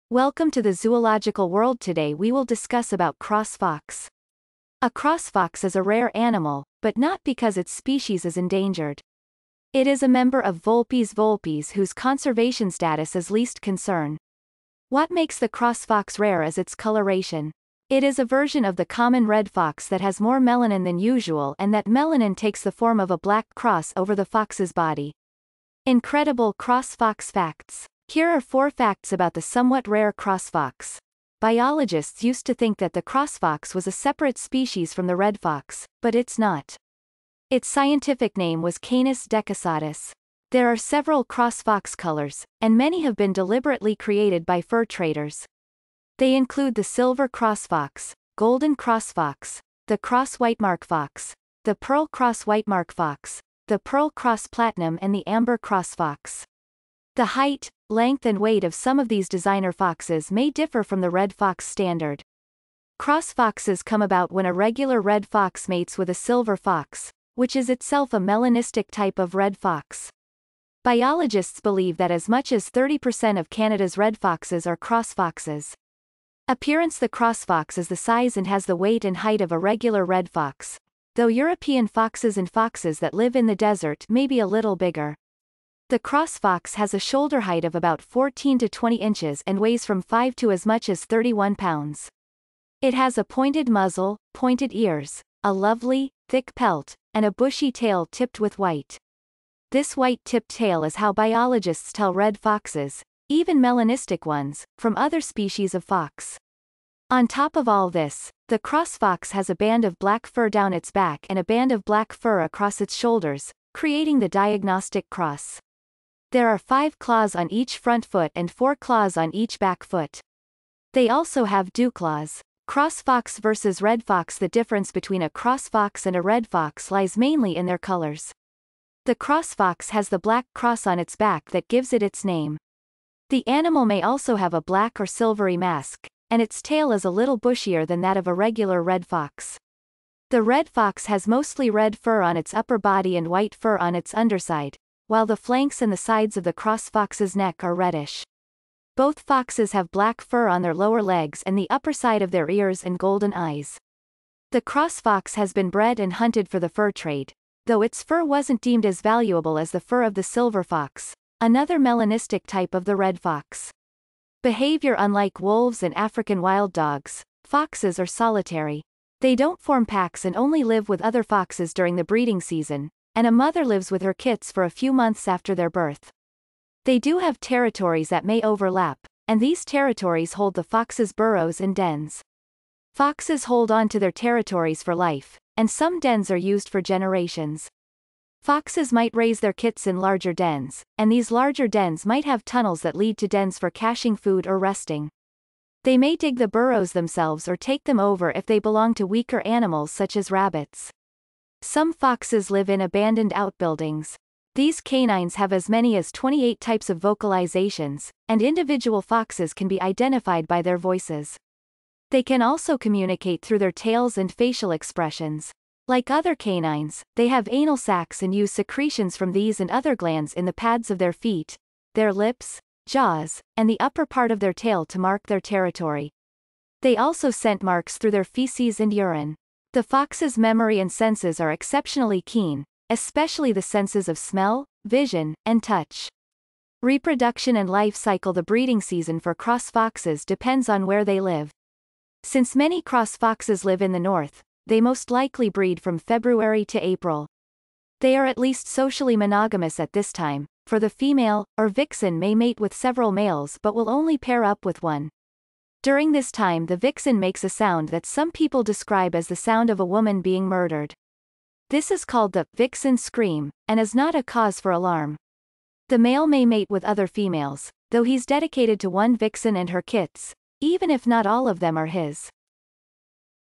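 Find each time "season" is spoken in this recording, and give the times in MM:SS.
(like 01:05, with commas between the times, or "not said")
02:52, 03:58.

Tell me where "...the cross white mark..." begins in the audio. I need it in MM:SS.
00:49.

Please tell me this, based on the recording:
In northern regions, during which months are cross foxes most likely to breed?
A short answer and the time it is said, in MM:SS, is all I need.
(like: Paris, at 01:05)
February to April, at 04:05.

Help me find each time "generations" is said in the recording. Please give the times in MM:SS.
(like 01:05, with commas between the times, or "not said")
03:06.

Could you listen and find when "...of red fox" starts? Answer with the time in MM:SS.
01:09.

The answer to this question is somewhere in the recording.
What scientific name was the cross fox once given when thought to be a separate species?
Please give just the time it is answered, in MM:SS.
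00:38.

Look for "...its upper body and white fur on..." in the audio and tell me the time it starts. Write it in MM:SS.
02:22.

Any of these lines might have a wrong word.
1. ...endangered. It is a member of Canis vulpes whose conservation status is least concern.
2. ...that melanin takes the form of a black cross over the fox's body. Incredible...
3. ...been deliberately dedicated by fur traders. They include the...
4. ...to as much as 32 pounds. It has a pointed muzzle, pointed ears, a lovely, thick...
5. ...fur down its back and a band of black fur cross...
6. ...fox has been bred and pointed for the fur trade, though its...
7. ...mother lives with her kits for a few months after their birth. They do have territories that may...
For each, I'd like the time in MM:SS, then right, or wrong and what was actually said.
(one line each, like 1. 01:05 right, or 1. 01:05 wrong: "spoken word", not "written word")
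1. 00:08 wrong: "Vulpes", not "Canis"
2. 00:21 right
3. 00:43 wrong: "created", not "dedicated"
4. 01:30 wrong: "31", not "32"
5. 01:50 wrong: "across", not "cross"
6. 02:35 wrong: "hunted", not "pointed"
7. 02:53 right.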